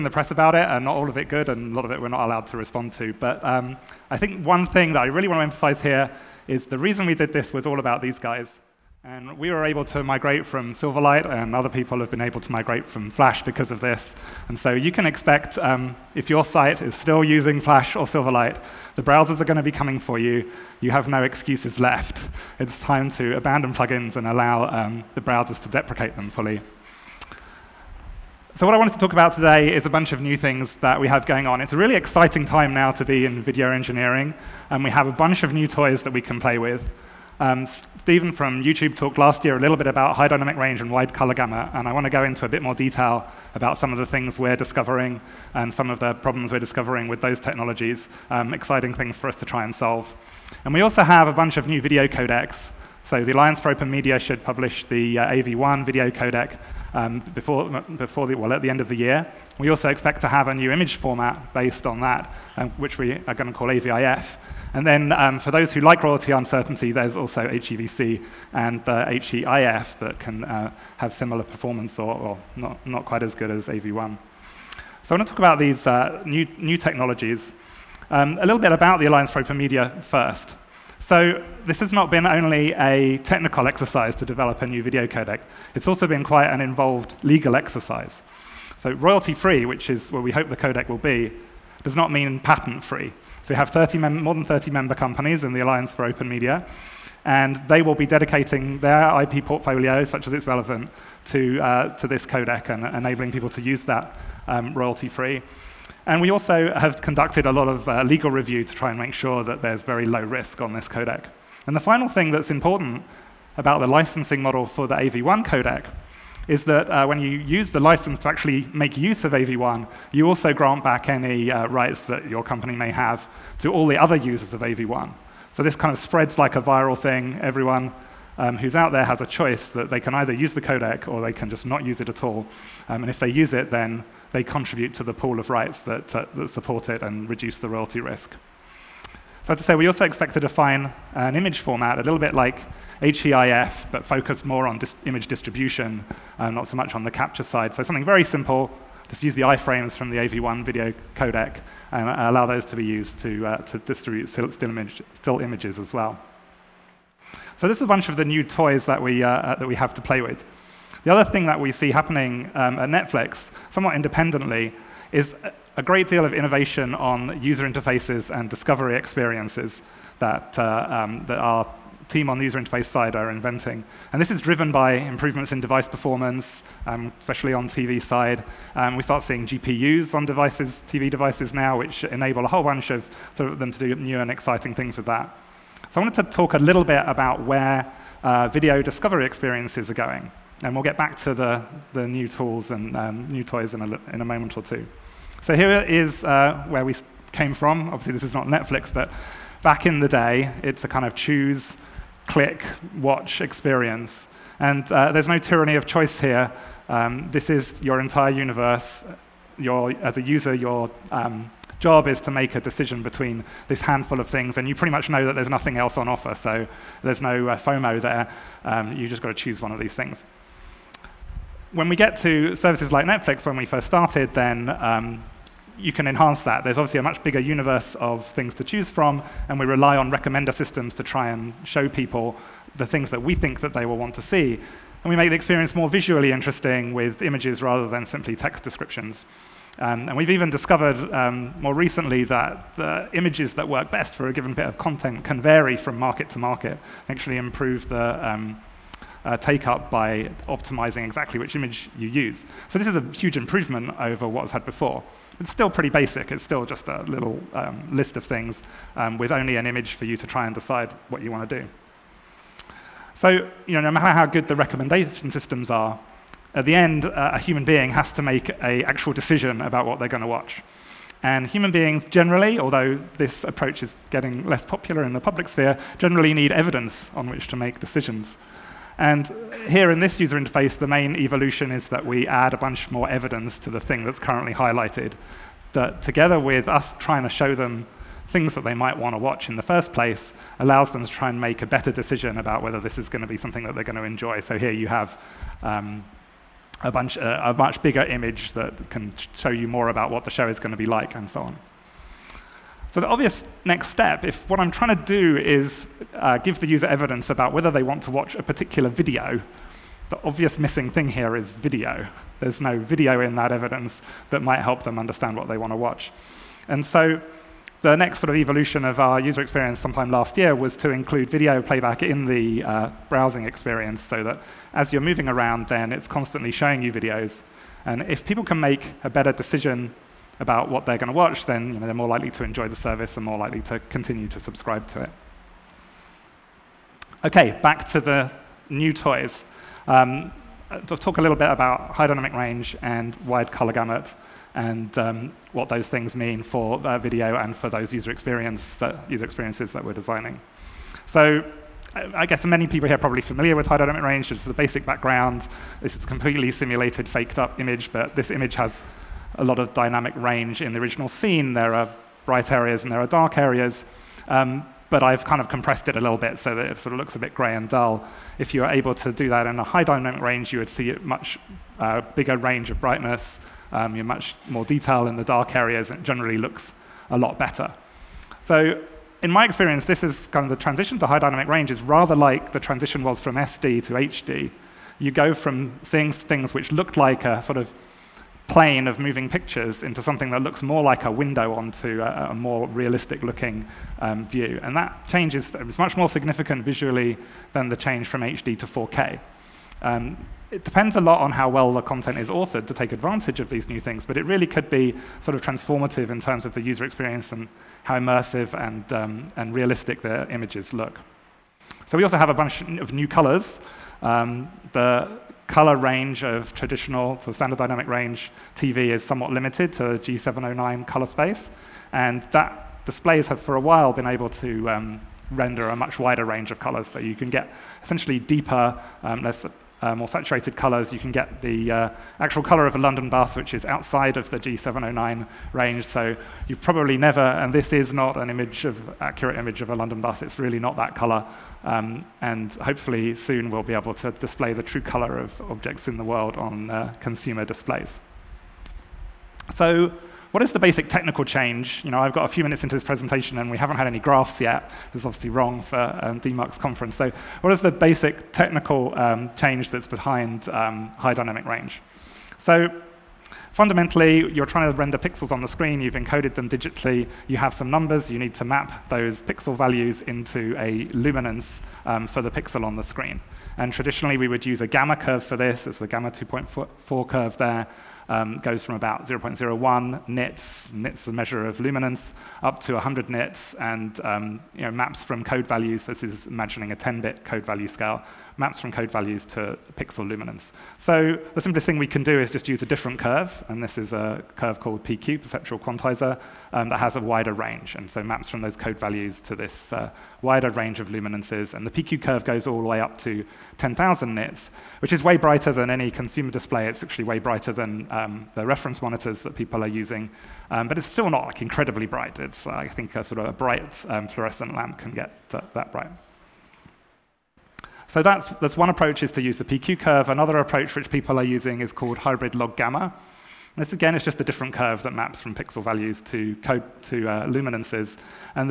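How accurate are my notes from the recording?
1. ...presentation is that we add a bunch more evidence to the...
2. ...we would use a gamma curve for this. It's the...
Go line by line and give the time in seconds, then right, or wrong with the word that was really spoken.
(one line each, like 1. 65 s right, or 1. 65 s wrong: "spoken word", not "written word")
1. 281 s wrong: "evolution", not "presentation"
2. 474 s right.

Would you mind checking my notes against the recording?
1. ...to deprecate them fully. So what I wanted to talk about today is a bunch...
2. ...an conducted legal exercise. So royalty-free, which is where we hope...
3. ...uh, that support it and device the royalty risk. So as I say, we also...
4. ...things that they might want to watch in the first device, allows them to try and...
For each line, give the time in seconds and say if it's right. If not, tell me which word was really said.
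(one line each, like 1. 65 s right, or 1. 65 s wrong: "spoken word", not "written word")
1. 25 s right
2. 86 s wrong: "involved", not "conducted"
3. 136 s wrong: "reduce", not "device"
4. 288 s wrong: "place", not "device".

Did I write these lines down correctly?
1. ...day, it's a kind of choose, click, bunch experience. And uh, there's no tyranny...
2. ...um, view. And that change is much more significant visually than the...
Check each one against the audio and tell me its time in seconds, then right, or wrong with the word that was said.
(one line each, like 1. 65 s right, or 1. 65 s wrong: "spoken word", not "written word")
1. 200 s wrong: "watch", not "bunch"
2. 393 s right.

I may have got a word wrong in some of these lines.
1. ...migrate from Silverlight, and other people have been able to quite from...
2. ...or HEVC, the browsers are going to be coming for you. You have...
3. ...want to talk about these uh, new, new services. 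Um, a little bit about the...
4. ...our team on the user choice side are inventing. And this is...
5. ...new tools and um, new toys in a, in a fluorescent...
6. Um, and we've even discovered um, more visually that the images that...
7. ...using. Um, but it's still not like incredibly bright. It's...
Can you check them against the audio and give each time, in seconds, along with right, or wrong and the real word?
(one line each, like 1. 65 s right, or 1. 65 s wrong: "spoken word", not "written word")
1. 10 s wrong: "migrate", not "quite"
2. 17 s wrong: "Silverlight", not "HEVC"
3. 75 s wrong: "technologies", not "services"
4. 171 s wrong: "interface", not "choice"
5. 192 s wrong: "moment", not "fluorescent"
6. 239 s wrong: "recently", not "visually"
7. 509 s right.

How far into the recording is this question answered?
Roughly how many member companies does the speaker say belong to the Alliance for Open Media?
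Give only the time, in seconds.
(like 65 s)
93 s.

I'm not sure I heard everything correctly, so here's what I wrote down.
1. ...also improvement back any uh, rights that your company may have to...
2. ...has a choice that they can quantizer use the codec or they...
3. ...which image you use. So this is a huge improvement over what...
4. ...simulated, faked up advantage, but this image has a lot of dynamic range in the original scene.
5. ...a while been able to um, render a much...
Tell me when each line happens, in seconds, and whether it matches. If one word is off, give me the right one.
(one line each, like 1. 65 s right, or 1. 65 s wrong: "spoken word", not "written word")
1. 120 s wrong: "grant", not "improvement"
2. 129 s wrong: "either", not "quantizer"
3. 251 s right
4. 356 s wrong: "image", not "advantage"
5. 423 s right.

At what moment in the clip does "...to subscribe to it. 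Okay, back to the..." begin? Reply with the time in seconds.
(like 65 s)
334 s.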